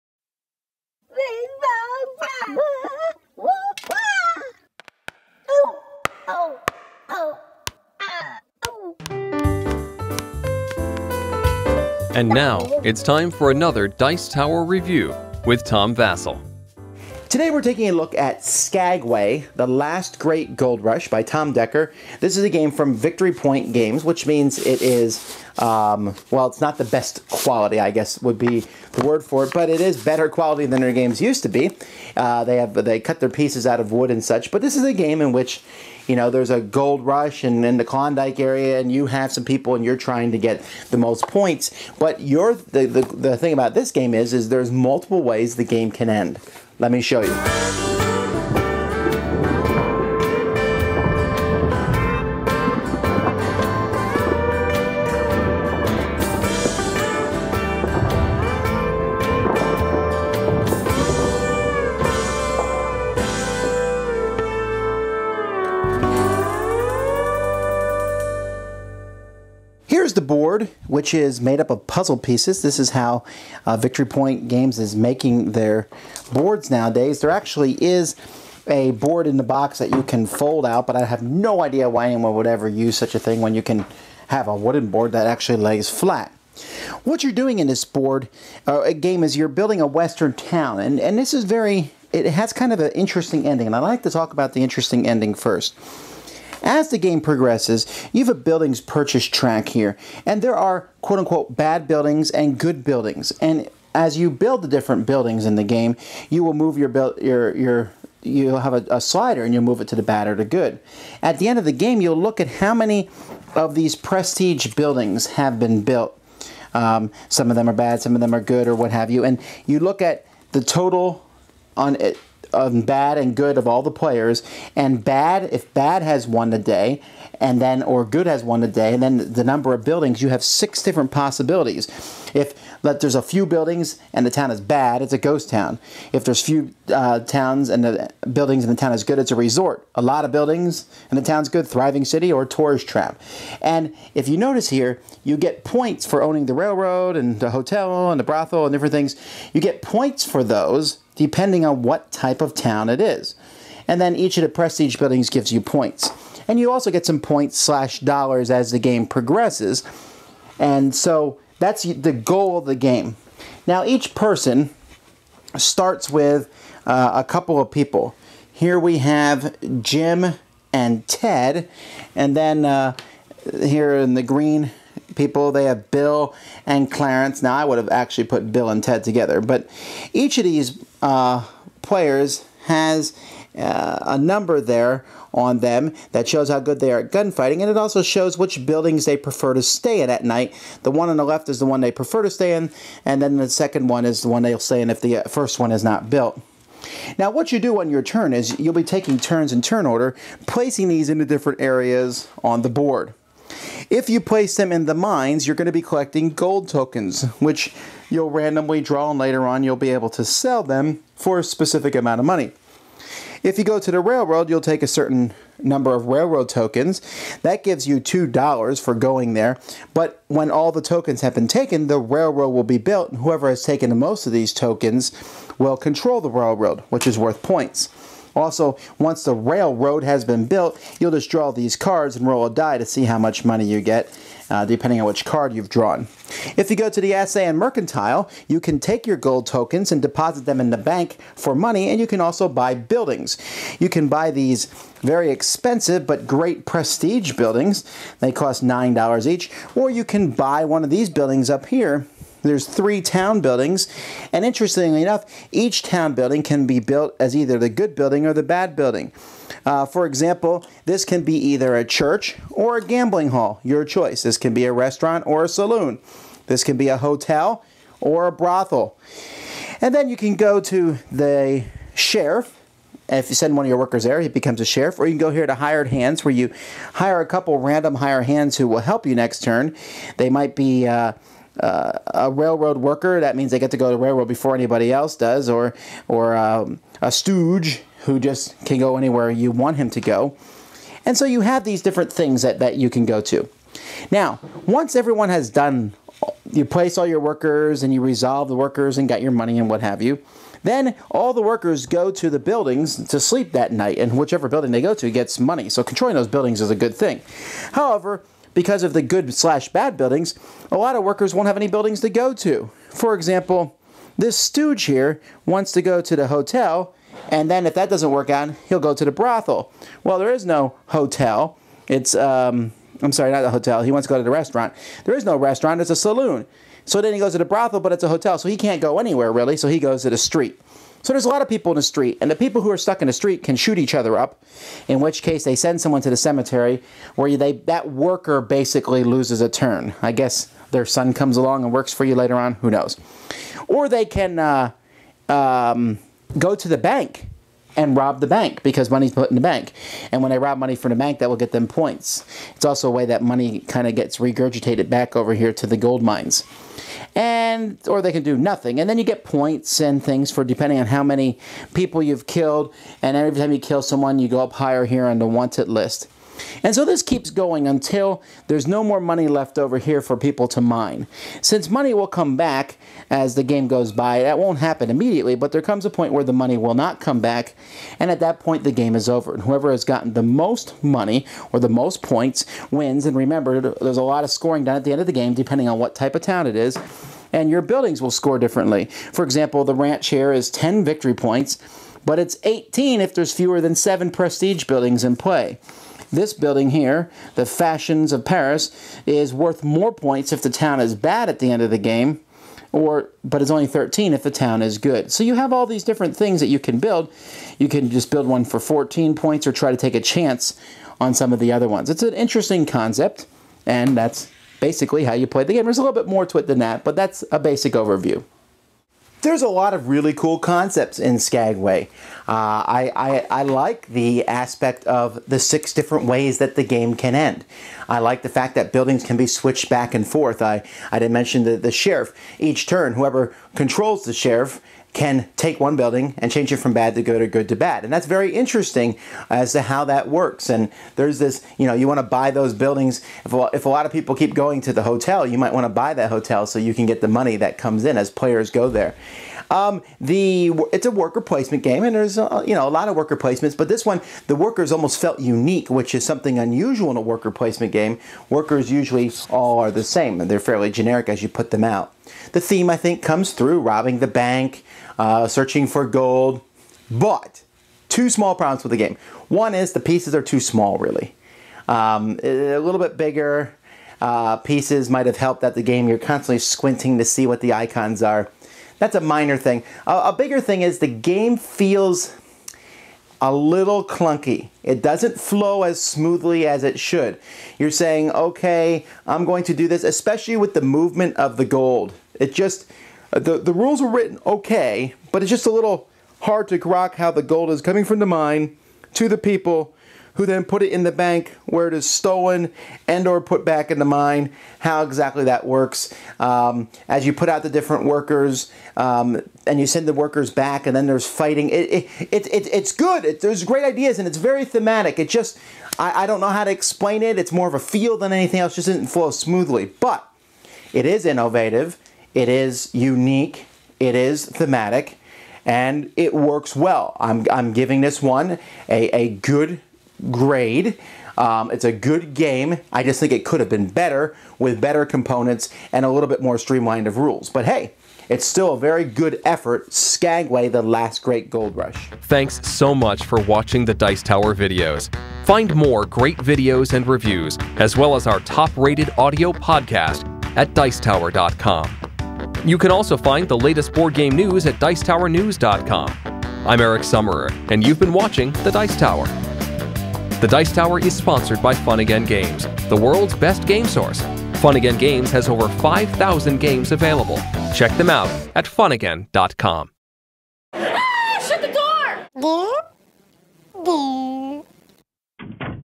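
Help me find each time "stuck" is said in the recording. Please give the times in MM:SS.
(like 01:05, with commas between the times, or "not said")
05:32.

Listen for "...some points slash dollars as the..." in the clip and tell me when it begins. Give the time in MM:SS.
02:37.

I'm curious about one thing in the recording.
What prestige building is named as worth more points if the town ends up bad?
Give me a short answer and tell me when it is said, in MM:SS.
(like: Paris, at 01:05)
Fashions of Paris, at 06:37.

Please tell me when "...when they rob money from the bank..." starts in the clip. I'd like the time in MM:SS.
05:50.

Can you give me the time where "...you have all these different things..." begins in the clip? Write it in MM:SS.
06:45.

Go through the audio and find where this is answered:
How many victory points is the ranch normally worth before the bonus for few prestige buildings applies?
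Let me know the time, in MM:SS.
06:30.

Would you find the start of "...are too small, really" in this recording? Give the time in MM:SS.
07:50.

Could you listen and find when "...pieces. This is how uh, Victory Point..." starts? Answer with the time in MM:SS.
01:12.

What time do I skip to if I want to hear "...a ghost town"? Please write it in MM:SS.
02:15.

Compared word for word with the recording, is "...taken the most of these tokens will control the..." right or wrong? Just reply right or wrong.
right.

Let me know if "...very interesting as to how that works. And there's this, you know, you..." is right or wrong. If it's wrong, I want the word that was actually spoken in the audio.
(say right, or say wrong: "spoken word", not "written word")
right.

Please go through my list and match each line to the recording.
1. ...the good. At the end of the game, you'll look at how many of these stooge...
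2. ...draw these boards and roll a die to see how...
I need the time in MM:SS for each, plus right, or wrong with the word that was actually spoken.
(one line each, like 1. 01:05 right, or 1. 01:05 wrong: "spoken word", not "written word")
1. 01:50 wrong: "prestige", not "stooge"
2. 03:51 wrong: "cards", not "boards".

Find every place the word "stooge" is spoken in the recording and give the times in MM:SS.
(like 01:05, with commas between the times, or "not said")
04:47, 05:14.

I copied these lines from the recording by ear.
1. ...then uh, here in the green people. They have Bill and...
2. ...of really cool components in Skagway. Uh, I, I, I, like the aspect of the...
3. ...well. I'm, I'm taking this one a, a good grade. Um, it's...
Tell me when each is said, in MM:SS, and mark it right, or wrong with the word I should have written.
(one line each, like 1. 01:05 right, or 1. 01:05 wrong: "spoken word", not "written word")
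1. 02:52 right
2. 06:59 wrong: "concepts", not "components"
3. 08:46 wrong: "giving", not "taking".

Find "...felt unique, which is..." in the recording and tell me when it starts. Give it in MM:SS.
07:34.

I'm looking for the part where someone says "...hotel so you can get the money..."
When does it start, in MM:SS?
07:26.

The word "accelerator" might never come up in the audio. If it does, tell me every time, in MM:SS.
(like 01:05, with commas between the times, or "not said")
not said.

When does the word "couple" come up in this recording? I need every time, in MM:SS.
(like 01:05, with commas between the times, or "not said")
02:47, 04:37.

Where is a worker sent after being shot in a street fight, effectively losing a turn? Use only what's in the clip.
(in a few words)
The cemetery.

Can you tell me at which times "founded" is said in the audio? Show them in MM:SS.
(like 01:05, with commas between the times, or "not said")
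not said.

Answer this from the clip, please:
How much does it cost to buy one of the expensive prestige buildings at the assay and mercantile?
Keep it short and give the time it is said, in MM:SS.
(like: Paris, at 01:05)
$9, at 04:08.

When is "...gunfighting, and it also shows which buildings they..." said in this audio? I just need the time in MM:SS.
03:07.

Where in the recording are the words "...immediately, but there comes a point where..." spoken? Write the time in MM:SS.
06:14.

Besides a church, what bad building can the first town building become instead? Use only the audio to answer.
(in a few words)
Gambling hall.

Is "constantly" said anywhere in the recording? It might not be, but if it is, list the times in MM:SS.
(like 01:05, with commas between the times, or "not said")
07:55.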